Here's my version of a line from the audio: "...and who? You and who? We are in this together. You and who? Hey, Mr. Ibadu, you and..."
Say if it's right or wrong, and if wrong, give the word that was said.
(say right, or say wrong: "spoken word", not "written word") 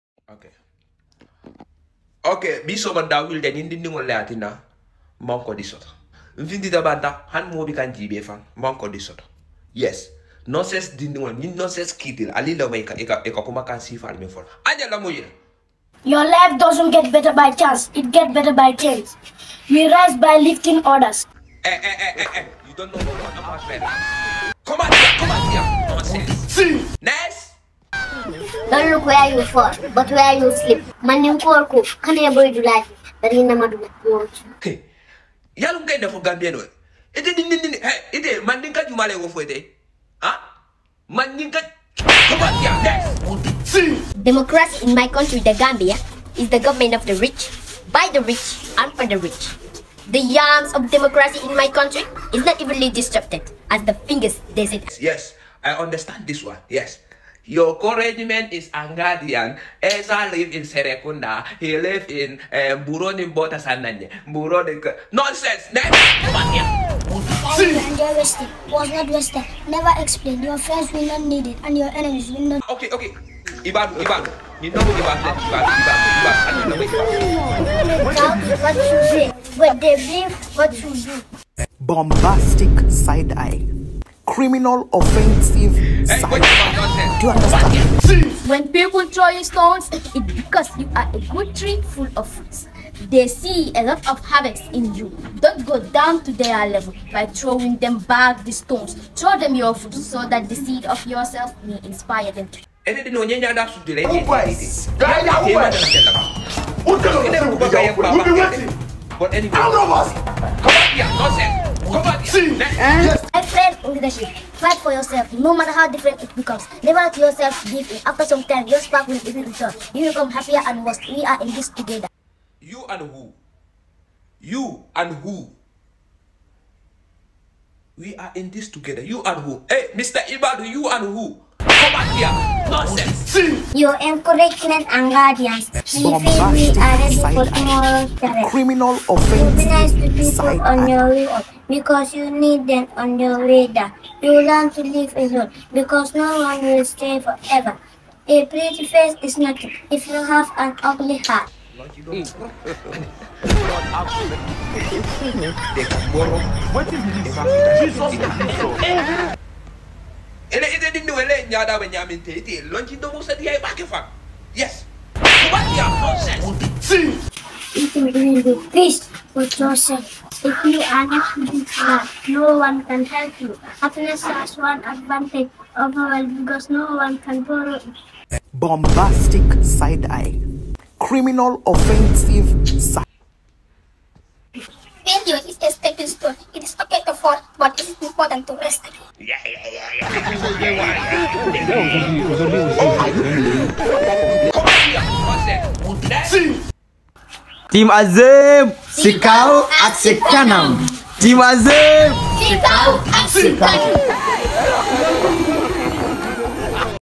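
right.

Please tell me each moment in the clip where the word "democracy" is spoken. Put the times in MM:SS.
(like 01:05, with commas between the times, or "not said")
00:44, 00:50.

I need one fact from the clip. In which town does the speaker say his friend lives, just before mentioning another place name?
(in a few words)
Serekunda.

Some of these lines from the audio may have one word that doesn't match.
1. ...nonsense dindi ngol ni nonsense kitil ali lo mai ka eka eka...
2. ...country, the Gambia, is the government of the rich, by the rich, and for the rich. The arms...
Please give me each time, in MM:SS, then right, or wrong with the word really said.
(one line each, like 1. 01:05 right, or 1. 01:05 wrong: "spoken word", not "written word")
1. 00:10 right
2. 00:45 right.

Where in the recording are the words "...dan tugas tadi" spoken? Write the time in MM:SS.
03:08.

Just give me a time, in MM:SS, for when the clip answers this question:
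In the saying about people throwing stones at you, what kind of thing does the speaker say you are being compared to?
01:31.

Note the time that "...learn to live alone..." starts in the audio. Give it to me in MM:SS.
02:24.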